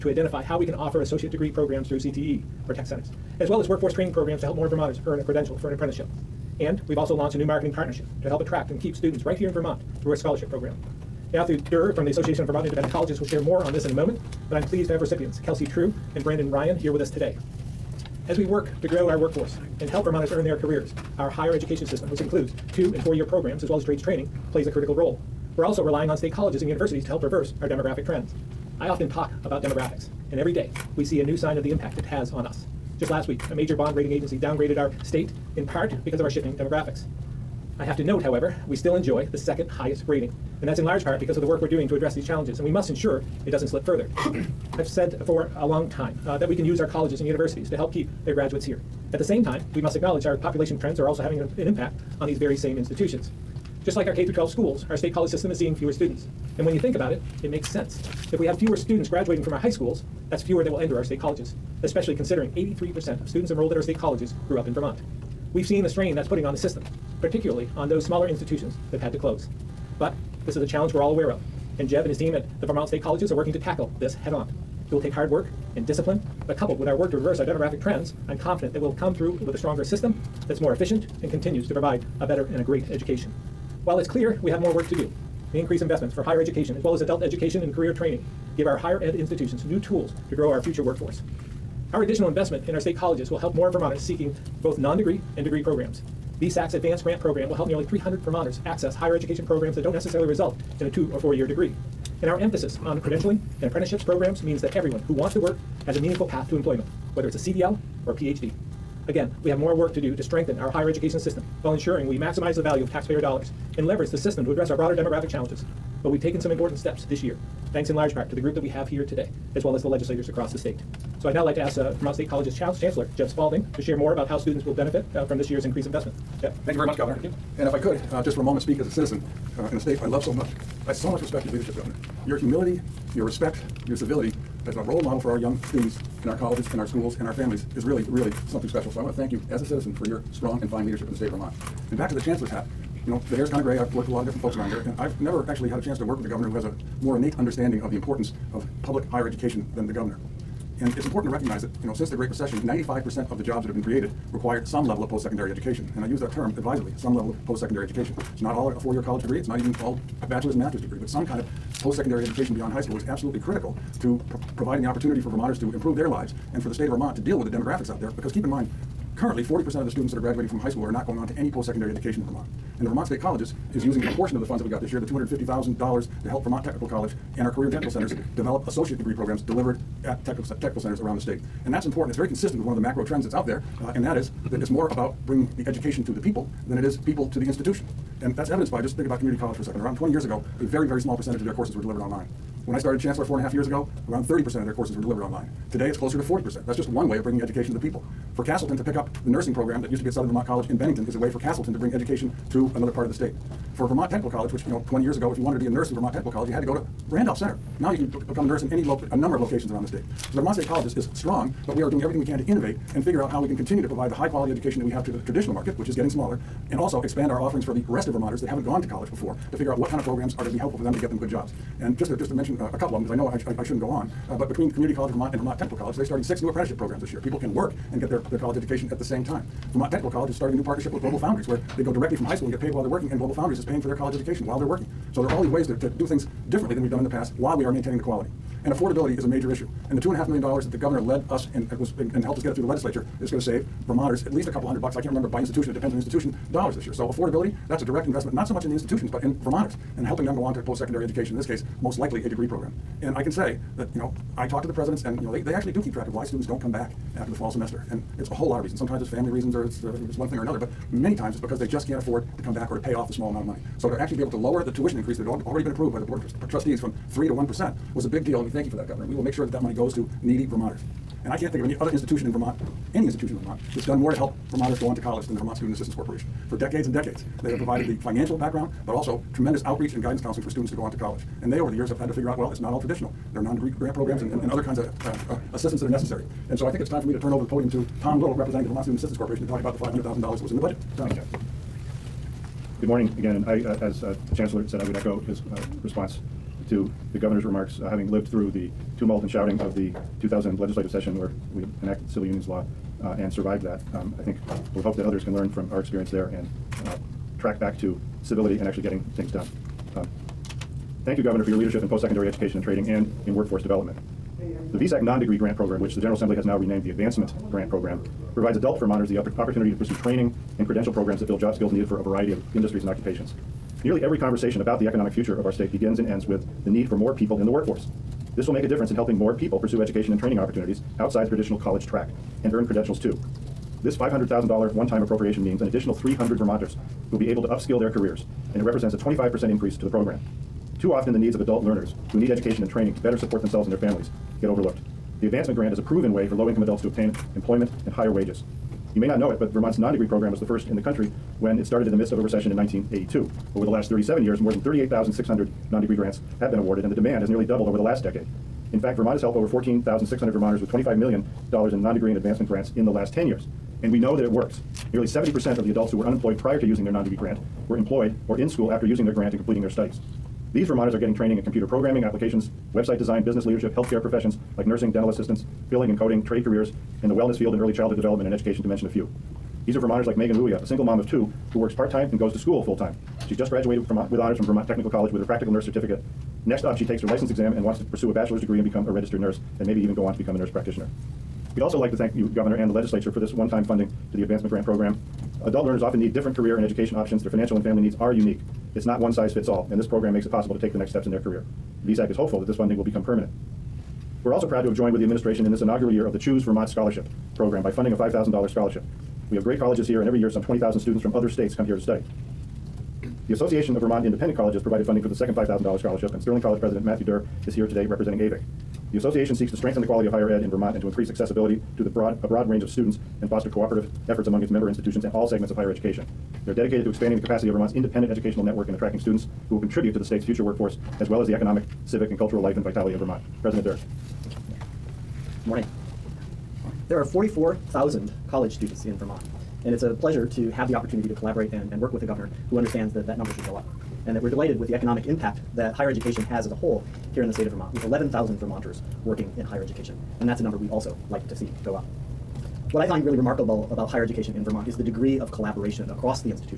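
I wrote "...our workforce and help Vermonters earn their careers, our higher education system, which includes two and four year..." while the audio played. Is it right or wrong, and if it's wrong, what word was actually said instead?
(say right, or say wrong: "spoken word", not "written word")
right.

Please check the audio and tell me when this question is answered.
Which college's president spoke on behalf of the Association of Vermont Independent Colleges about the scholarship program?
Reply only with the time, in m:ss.
6:56.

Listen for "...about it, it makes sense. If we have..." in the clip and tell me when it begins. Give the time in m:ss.
0:56.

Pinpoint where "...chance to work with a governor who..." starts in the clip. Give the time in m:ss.
2:25.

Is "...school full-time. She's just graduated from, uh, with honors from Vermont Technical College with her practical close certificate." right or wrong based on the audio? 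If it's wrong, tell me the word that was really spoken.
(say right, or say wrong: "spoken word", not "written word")
wrong: "nurse", not "close".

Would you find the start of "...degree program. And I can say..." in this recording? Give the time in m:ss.
4:12.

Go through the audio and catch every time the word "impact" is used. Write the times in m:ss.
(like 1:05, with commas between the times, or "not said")
0:31, 0:51, 7:25.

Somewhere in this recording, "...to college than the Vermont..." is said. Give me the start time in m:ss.
4:34.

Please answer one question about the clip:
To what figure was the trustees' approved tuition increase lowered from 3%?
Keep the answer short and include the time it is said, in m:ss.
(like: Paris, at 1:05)
1%, at 4:27.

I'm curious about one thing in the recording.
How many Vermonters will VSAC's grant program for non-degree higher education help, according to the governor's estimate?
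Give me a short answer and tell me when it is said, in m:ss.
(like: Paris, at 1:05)
nearly 300, at 1:37.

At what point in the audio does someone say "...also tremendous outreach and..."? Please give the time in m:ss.
4:38.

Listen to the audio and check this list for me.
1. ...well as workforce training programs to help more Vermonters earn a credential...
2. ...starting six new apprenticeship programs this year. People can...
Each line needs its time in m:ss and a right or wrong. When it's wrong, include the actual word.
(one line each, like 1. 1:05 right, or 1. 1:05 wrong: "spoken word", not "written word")
1. 0:03 right
2. 3:46 right.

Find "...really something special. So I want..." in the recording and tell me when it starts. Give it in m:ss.
2:18.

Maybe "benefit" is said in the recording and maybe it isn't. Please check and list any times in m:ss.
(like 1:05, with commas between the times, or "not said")
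2:04.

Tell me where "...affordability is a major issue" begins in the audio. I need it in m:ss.
3:58.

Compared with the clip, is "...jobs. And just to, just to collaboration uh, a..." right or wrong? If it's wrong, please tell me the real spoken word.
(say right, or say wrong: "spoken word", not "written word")
wrong: "mention", not "collaboration".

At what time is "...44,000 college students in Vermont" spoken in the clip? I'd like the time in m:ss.
7:17.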